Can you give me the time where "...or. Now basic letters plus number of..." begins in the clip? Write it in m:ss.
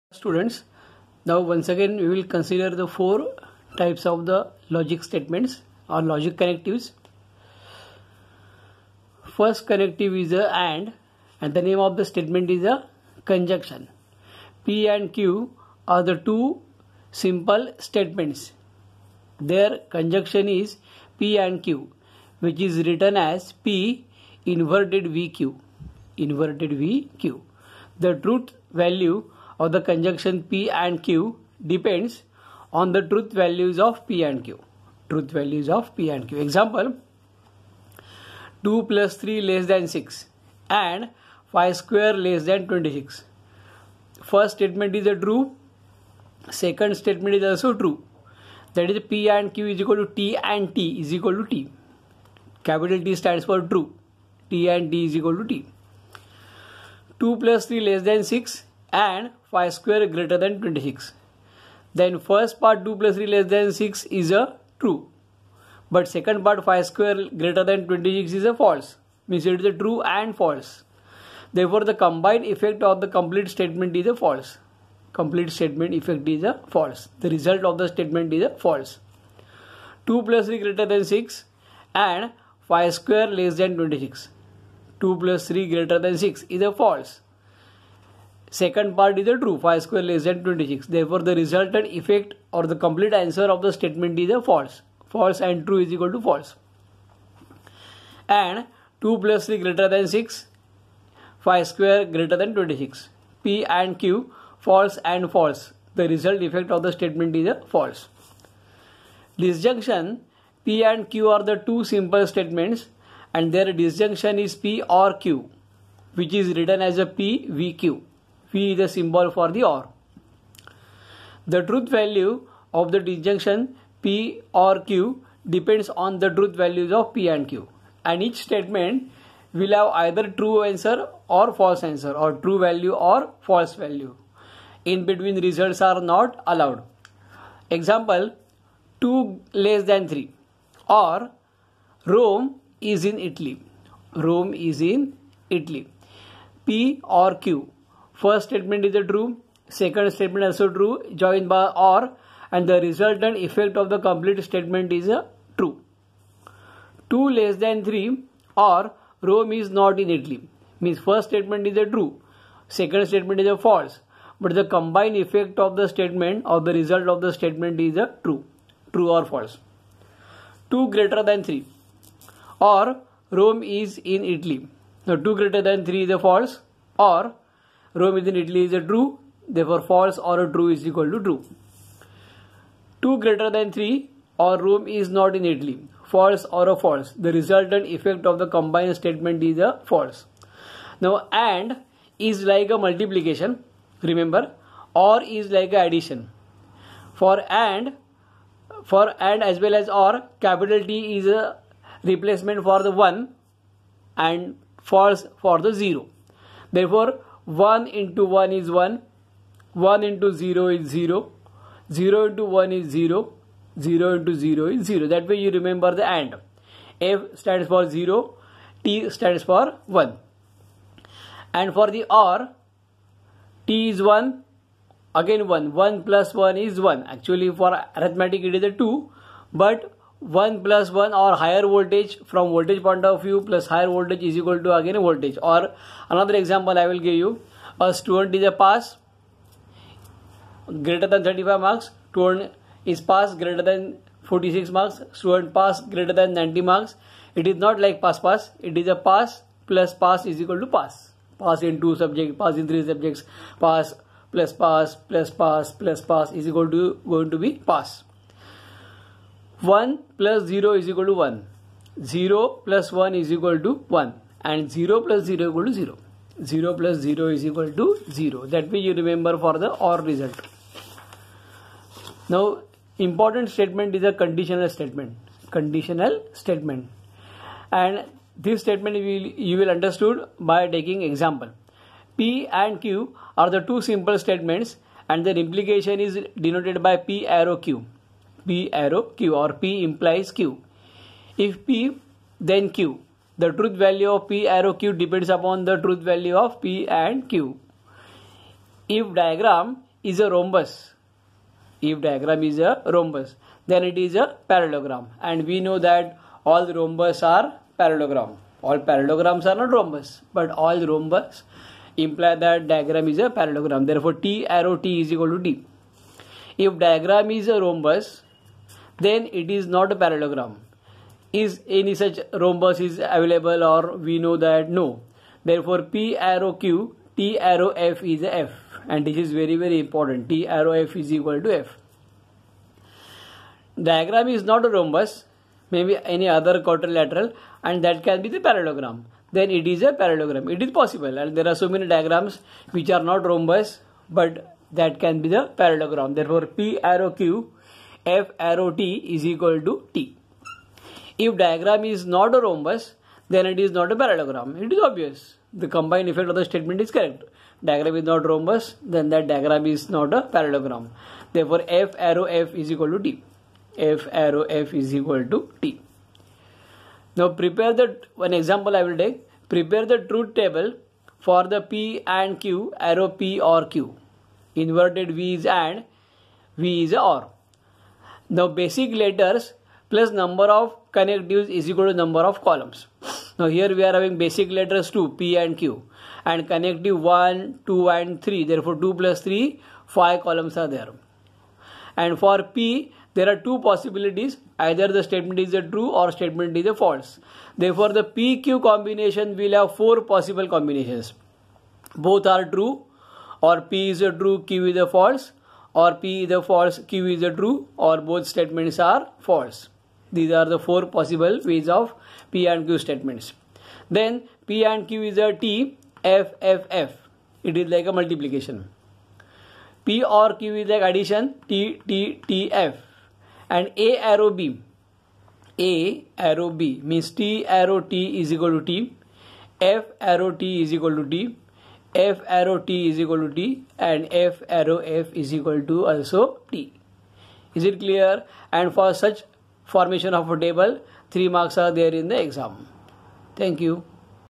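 6:16.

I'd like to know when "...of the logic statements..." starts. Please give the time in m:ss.
0:04.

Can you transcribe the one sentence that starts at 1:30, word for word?
Therefore, the resultant effect or the complete answer of the statement is a false.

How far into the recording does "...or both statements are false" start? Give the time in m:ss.
6:47.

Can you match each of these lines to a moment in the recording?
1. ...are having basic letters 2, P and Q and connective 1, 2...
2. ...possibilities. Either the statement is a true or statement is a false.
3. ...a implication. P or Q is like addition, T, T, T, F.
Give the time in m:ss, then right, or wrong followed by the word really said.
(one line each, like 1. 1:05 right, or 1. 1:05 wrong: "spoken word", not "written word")
1. 6:23 right
2. 6:33 right
3. 6:57 wrong: "multiplication", not "implication".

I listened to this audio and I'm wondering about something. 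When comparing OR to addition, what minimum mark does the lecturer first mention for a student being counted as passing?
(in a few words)
35.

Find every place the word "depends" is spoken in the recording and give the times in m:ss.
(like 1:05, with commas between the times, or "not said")
0:31, 2:05, 4:54.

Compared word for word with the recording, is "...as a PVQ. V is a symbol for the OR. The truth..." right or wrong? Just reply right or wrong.
right.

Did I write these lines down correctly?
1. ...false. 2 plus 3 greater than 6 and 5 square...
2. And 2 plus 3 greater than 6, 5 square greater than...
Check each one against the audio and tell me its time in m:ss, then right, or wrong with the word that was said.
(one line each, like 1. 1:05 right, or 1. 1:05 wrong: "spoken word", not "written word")
1. 1:18 right
2. 1:38 right.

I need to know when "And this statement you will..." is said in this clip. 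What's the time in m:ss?
4:37.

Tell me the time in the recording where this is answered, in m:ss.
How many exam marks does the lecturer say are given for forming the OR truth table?
7:21.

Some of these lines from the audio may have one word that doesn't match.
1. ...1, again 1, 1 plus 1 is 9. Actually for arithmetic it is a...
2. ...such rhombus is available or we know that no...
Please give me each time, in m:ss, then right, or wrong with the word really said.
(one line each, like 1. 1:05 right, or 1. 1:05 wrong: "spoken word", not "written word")
1. 3:44 wrong: "1", not "9"
2. 5:21 right.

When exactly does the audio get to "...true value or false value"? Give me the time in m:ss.
2:12.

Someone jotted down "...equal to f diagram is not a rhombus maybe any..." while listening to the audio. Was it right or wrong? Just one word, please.
right.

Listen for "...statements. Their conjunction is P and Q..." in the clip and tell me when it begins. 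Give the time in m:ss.
0:17.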